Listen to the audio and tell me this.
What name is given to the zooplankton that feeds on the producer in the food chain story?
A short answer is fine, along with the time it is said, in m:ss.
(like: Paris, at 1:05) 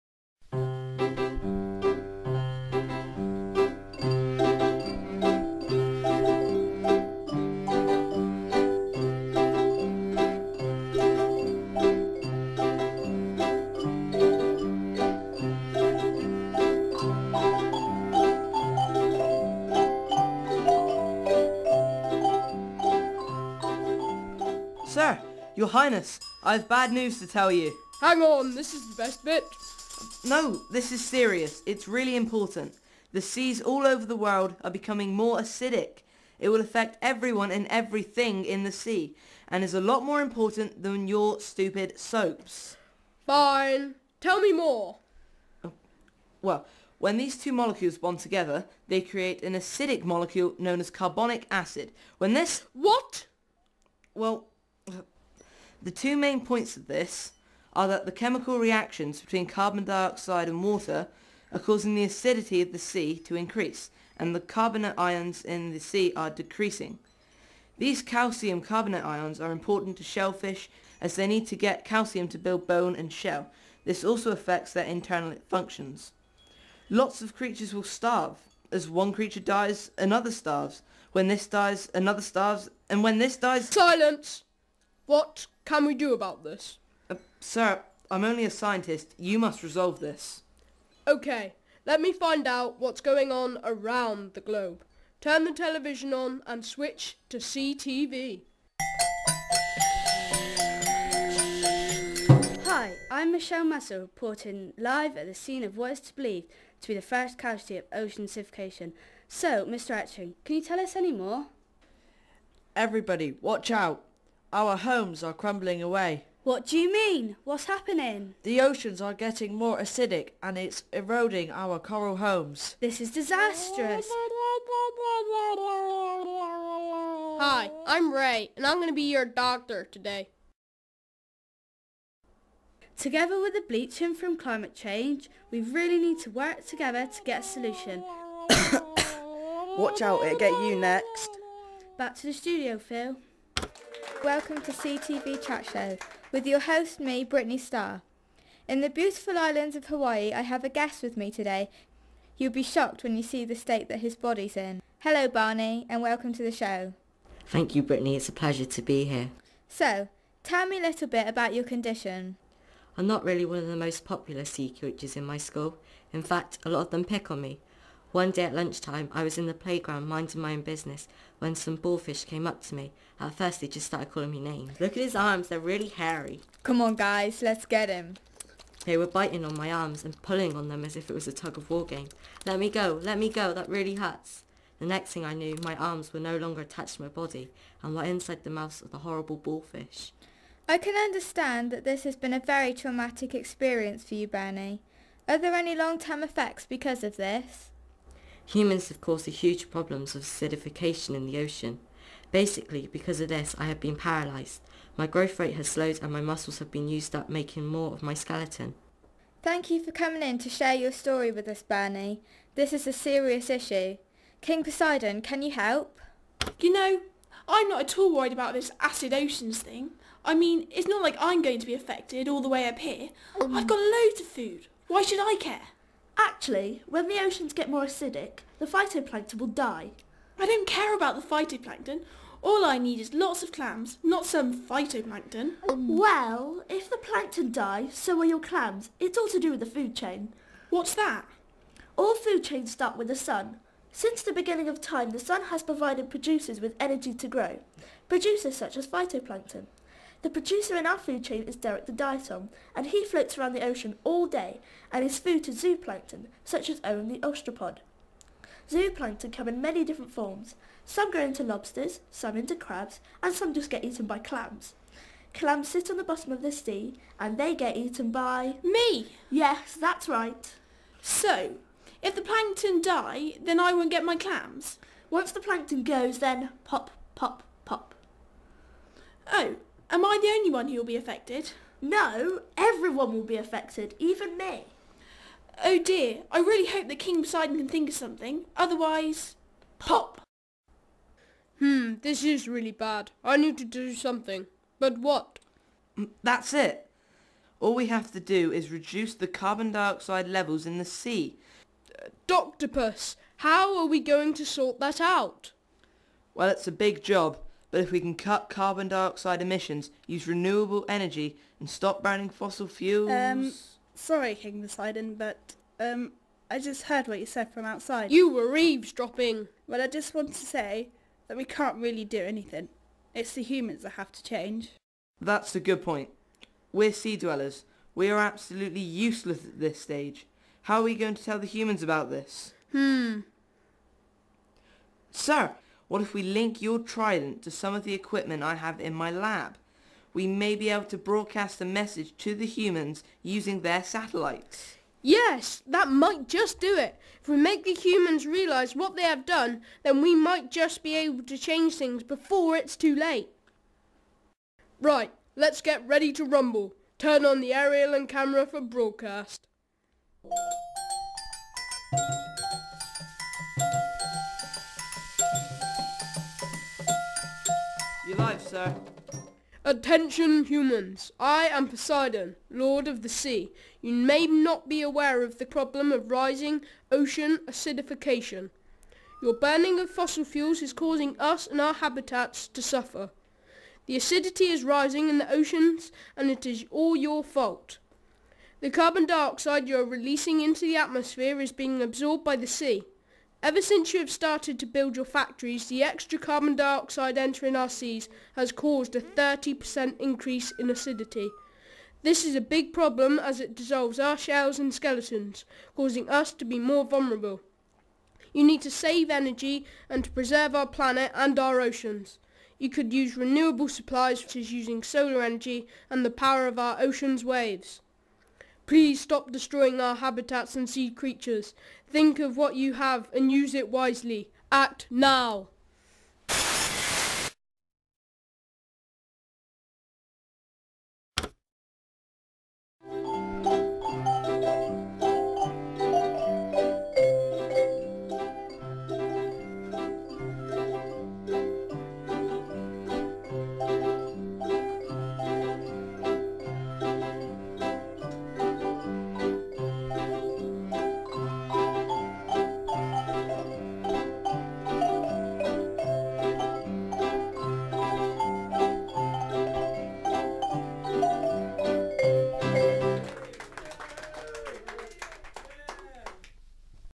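Owen, at 4:16.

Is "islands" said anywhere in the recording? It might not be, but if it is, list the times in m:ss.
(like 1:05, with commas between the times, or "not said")
2:29.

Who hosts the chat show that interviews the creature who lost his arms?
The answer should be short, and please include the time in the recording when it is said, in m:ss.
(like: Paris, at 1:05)
Brittany Starr, at 2:27.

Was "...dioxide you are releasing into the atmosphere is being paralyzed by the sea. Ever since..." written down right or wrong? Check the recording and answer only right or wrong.
wrong.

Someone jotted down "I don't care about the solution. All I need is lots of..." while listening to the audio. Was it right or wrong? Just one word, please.
wrong.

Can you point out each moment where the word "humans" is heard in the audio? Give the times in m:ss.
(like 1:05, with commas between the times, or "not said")
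3:18, 5:23, 5:31, 5:42, 5:47, 6:10.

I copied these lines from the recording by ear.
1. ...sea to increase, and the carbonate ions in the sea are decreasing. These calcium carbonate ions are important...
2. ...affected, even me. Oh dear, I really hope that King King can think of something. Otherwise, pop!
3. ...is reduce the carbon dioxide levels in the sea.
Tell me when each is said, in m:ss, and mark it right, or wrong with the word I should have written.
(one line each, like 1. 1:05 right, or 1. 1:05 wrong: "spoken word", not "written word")
1. 1:02 right
2. 4:43 wrong: "Poseidon", not "King"
3. 4:58 right.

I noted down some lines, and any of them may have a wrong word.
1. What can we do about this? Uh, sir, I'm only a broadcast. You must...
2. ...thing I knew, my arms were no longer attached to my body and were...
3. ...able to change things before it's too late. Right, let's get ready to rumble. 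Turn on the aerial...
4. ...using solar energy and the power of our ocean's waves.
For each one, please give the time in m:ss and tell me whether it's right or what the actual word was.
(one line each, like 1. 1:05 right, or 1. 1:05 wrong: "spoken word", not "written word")
1. 1:25 wrong: "scientist", not "broadcast"
2. 3:05 right
3. 5:50 right
4. 6:54 right.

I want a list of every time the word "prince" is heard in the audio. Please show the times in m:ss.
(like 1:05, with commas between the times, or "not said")
not said.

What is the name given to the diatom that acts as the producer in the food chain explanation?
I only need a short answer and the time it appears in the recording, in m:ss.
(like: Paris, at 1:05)
Derek, at 4:11.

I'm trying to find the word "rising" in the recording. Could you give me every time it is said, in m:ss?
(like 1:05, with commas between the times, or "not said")
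6:16, 6:24.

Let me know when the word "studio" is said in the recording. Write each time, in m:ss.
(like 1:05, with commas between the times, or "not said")
2:22.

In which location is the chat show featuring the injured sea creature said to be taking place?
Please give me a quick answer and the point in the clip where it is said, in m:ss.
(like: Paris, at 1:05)
Hawaii, at 2:29.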